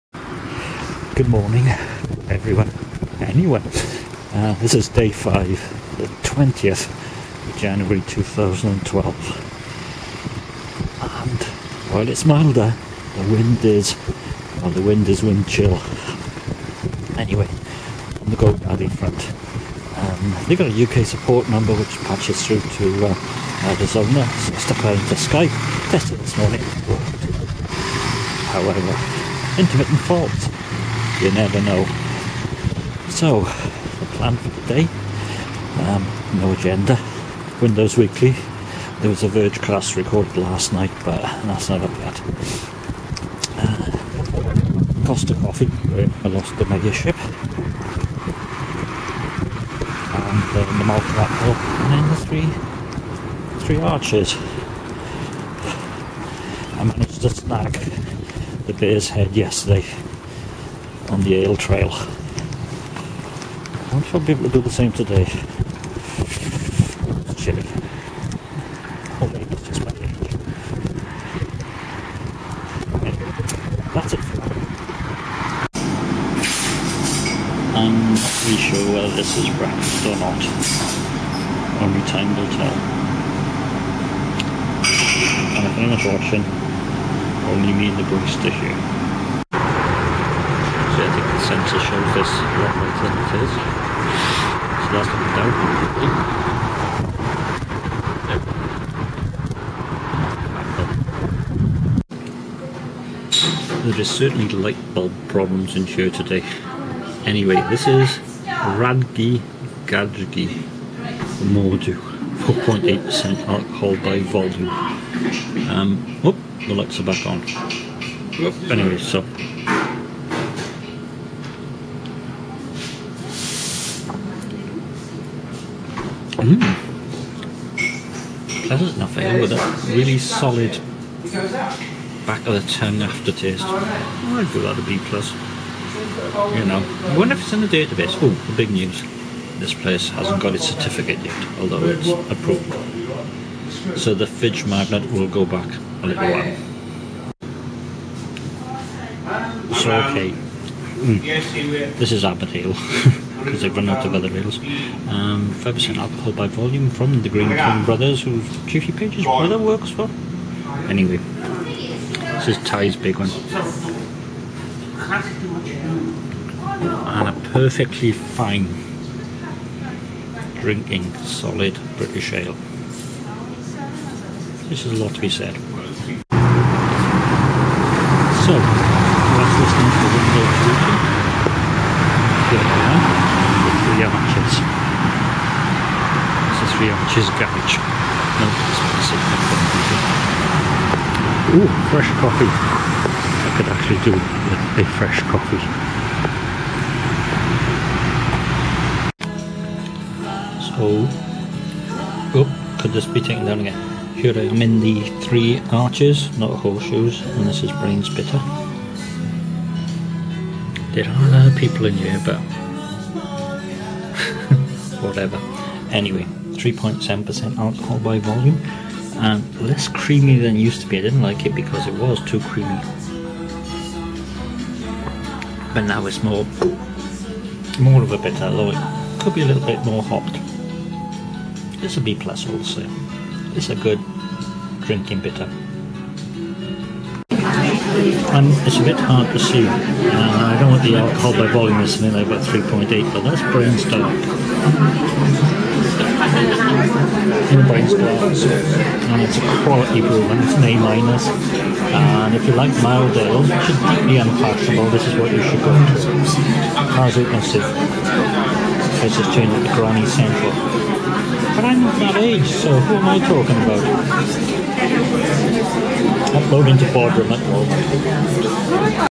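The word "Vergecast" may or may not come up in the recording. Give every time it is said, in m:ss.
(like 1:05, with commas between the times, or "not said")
0:39.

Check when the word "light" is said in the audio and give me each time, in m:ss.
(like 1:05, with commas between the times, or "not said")
1:44, 1:56.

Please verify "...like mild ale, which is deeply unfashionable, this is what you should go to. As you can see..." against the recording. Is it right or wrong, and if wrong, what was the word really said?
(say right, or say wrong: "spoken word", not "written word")
right.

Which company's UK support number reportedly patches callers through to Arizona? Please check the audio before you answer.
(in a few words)
GoDaddy.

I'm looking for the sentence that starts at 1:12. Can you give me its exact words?
Anyway, that's it I'm not really sure whether this is breakfast or not.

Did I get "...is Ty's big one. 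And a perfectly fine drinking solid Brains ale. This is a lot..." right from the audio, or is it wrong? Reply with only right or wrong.
wrong.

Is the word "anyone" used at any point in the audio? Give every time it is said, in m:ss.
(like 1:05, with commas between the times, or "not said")
0:03, 1:25.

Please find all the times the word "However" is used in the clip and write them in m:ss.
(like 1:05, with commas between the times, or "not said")
0:28.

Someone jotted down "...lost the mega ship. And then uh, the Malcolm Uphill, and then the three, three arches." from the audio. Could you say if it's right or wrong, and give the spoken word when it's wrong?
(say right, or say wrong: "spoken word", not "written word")
right.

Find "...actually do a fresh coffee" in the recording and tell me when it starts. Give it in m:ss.
3:13.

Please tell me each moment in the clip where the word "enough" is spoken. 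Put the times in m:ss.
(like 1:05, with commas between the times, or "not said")
2:08.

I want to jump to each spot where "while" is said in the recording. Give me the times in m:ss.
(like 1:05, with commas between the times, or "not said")
0:11, 2:26.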